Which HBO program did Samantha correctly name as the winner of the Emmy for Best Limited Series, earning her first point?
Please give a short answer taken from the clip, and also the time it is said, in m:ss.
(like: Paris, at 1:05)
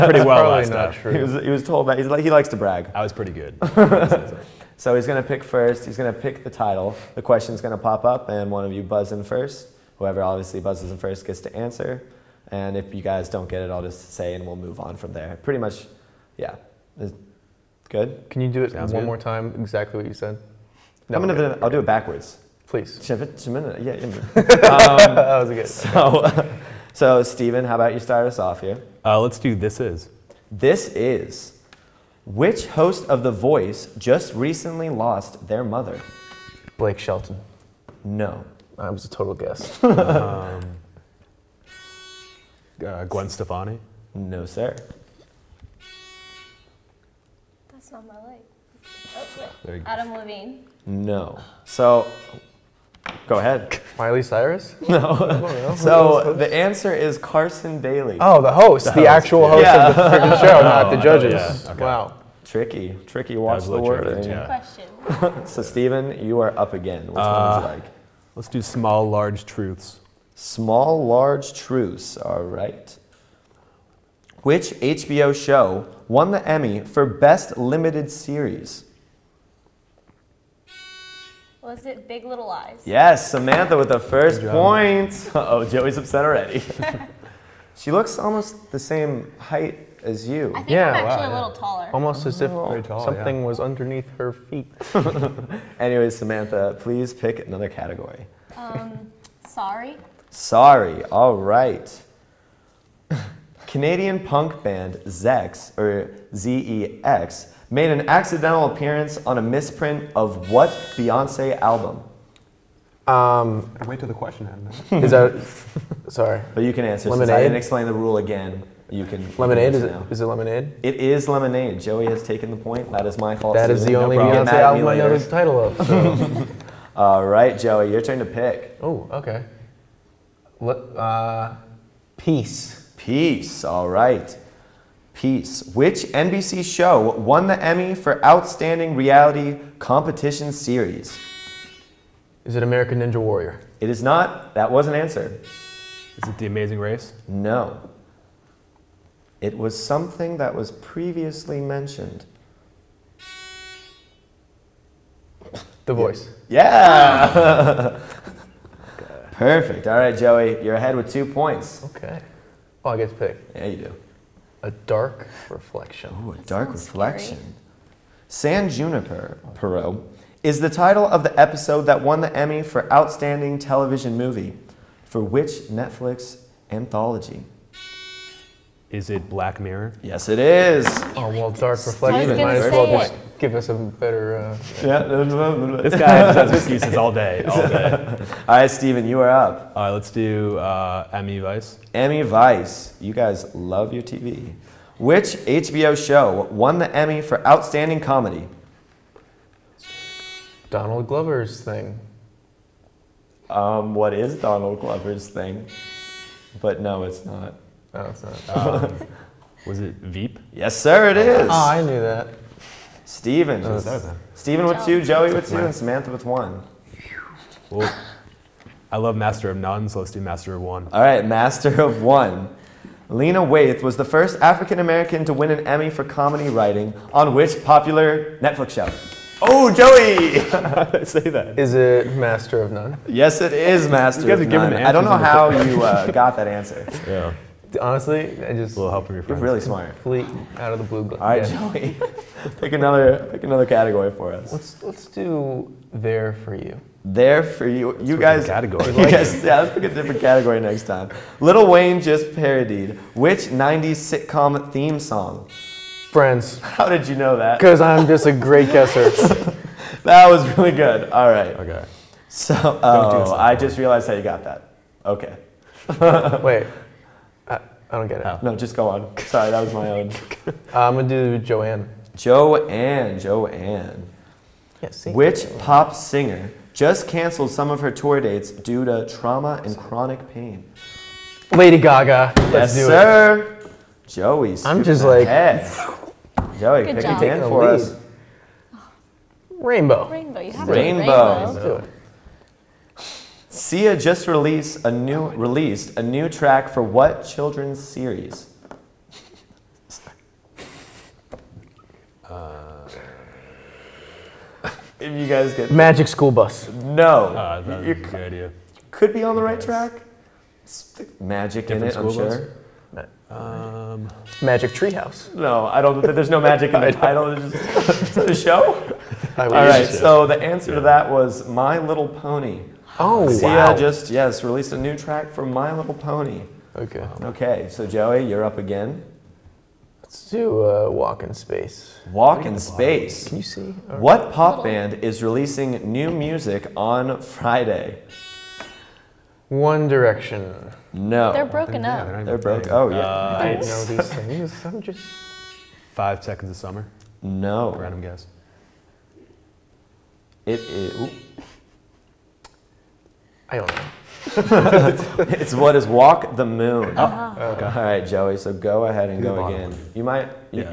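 Big Little Lies, at 1:22.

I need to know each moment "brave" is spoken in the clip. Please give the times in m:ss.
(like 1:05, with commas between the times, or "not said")
not said.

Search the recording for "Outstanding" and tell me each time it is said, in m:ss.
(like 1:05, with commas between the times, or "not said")
2:18, 2:52, 3:17.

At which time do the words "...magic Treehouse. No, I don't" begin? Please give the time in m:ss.
5:14.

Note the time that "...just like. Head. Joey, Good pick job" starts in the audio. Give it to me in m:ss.
4:44.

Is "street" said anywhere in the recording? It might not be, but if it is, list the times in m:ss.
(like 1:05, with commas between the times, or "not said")
not said.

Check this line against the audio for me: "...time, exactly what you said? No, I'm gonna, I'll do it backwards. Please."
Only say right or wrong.
right.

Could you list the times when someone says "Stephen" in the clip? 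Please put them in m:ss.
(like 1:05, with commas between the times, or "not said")
0:27, 1:05.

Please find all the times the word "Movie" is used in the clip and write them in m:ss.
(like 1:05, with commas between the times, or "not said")
2:54.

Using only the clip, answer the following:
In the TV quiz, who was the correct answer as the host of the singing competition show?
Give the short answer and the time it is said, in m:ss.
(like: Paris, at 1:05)
Carson Daly, at 0:57.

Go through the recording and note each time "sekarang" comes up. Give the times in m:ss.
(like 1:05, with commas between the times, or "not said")
not said.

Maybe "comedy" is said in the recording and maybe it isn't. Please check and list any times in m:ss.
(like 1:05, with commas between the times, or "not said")
3:18, 3:46.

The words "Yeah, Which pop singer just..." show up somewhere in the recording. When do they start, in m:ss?
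4:34.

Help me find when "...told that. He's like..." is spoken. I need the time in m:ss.
0:01.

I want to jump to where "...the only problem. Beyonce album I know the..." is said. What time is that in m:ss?
2:03.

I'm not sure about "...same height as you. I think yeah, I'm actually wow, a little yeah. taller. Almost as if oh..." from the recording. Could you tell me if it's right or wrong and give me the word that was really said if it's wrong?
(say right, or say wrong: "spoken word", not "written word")
right.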